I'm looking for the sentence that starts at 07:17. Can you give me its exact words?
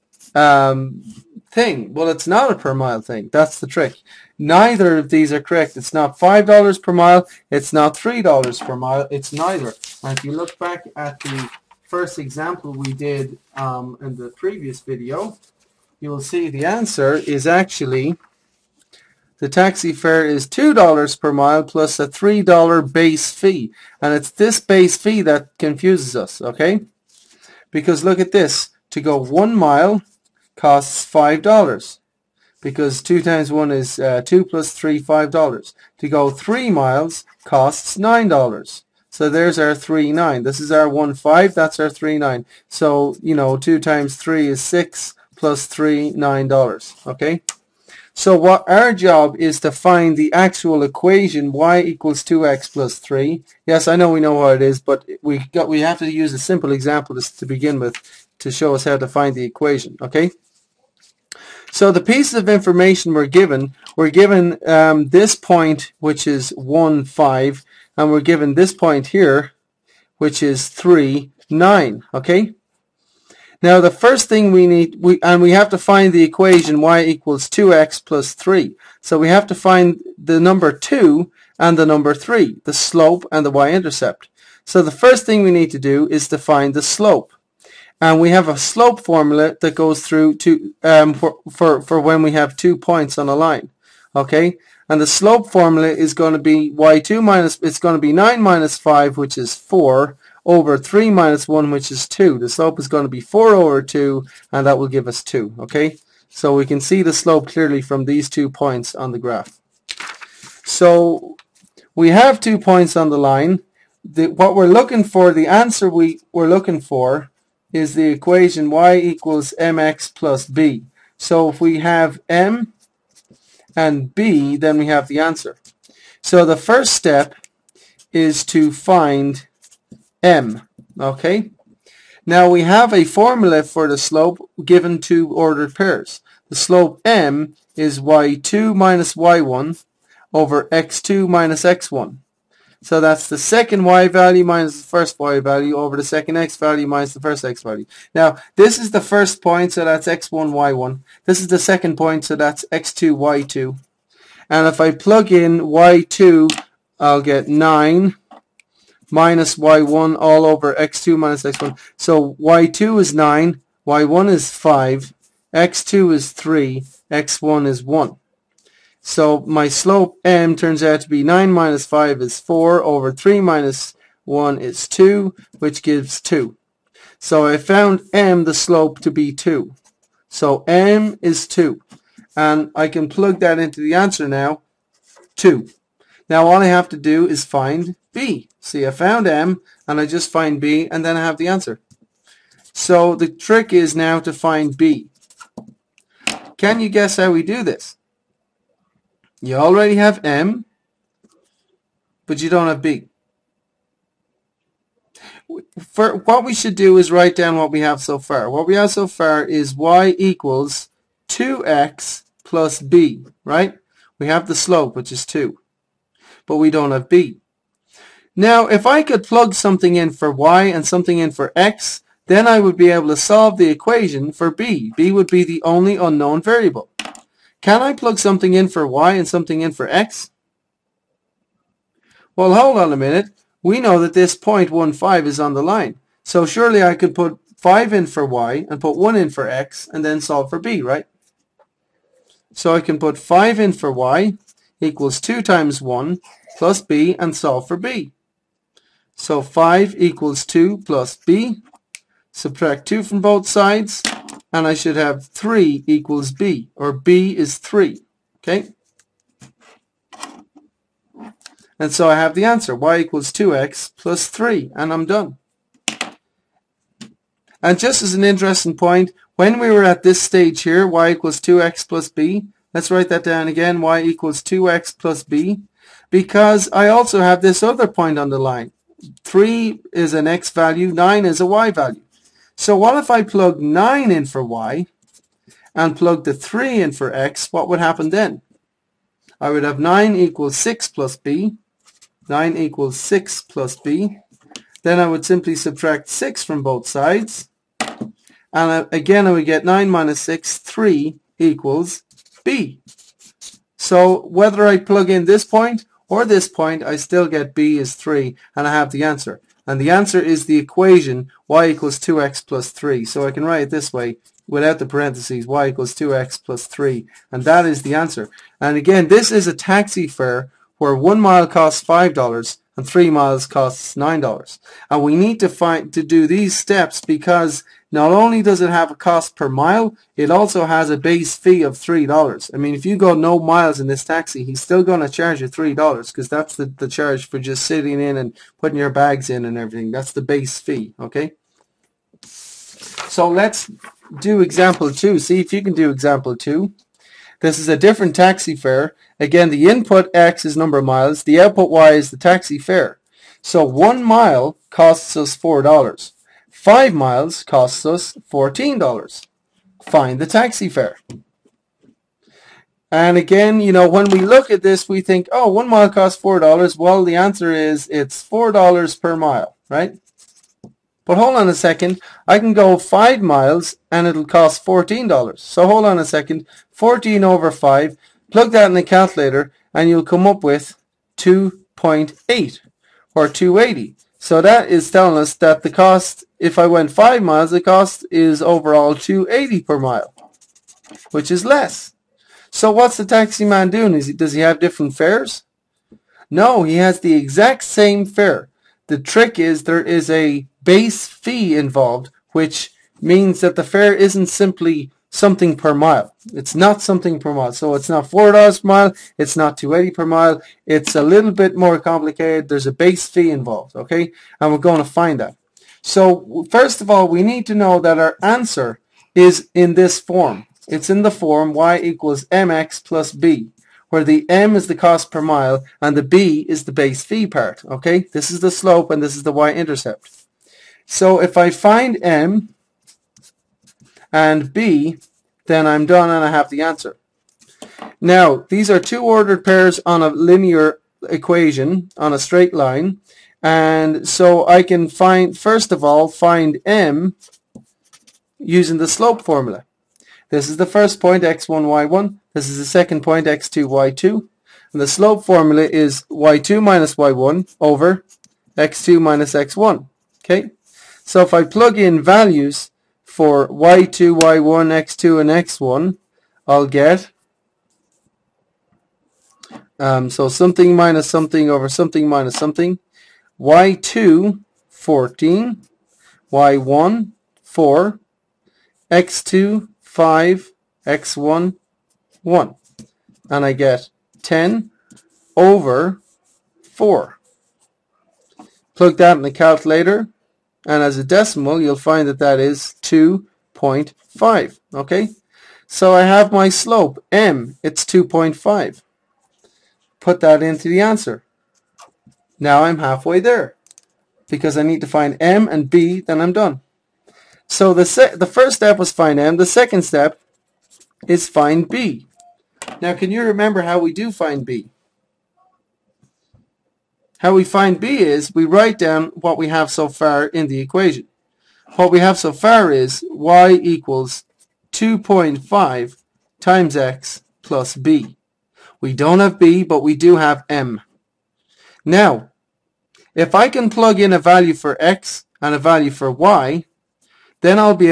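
Now, these are two ordered pairs on a linear equation, on a straight line.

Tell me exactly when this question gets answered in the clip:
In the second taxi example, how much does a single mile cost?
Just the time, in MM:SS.
05:53.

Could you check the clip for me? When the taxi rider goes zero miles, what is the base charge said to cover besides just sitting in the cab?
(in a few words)
putting your bags in.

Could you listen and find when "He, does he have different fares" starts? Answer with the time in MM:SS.
06:33.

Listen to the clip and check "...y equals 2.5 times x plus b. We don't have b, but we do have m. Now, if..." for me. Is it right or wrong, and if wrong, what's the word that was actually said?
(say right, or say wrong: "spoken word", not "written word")
right.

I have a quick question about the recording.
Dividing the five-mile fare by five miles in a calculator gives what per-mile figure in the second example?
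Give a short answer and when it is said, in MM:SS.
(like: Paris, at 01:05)
2.8, at 06:21.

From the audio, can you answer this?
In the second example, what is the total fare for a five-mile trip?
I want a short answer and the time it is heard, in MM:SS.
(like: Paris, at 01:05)
$14, at 05:56.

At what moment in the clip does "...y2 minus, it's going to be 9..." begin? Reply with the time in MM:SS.
01:36.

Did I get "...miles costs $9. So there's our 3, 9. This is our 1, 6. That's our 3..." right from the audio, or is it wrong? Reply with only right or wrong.
wrong.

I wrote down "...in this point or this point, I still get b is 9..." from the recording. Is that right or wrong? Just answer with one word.
wrong.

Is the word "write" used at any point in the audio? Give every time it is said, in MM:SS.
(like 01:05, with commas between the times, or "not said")
03:27, 04:32, 05:13, 08:38.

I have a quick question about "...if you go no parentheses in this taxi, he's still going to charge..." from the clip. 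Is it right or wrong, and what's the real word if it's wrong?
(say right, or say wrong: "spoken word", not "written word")
wrong: "miles", not "parentheses".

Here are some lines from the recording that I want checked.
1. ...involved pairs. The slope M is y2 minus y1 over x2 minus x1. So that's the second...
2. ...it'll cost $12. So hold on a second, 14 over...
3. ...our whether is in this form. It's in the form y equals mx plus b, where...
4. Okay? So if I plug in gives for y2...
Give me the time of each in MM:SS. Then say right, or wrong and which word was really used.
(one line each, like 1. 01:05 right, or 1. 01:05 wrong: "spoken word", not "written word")
1. 02:15 wrong: "ordered", not "involved"
2. 06:14 wrong: "14", not "12"
3. 06:57 wrong: "answer", not "whether"
4. 07:40 wrong: "values", not "gives".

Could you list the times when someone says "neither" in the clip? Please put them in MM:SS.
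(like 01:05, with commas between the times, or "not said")
00:04, 00:09.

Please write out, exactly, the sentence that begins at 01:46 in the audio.
So we can see the slope clearly from these two points on the graph.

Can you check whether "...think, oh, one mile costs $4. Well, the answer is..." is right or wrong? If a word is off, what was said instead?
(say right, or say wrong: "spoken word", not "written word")
right.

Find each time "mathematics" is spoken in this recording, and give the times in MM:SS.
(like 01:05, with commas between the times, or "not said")
not said.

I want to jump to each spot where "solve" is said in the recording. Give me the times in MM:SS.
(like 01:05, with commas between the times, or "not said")
03:43, 04:00, 04:07.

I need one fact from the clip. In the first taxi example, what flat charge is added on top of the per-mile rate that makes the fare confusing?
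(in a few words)
$3 base fee.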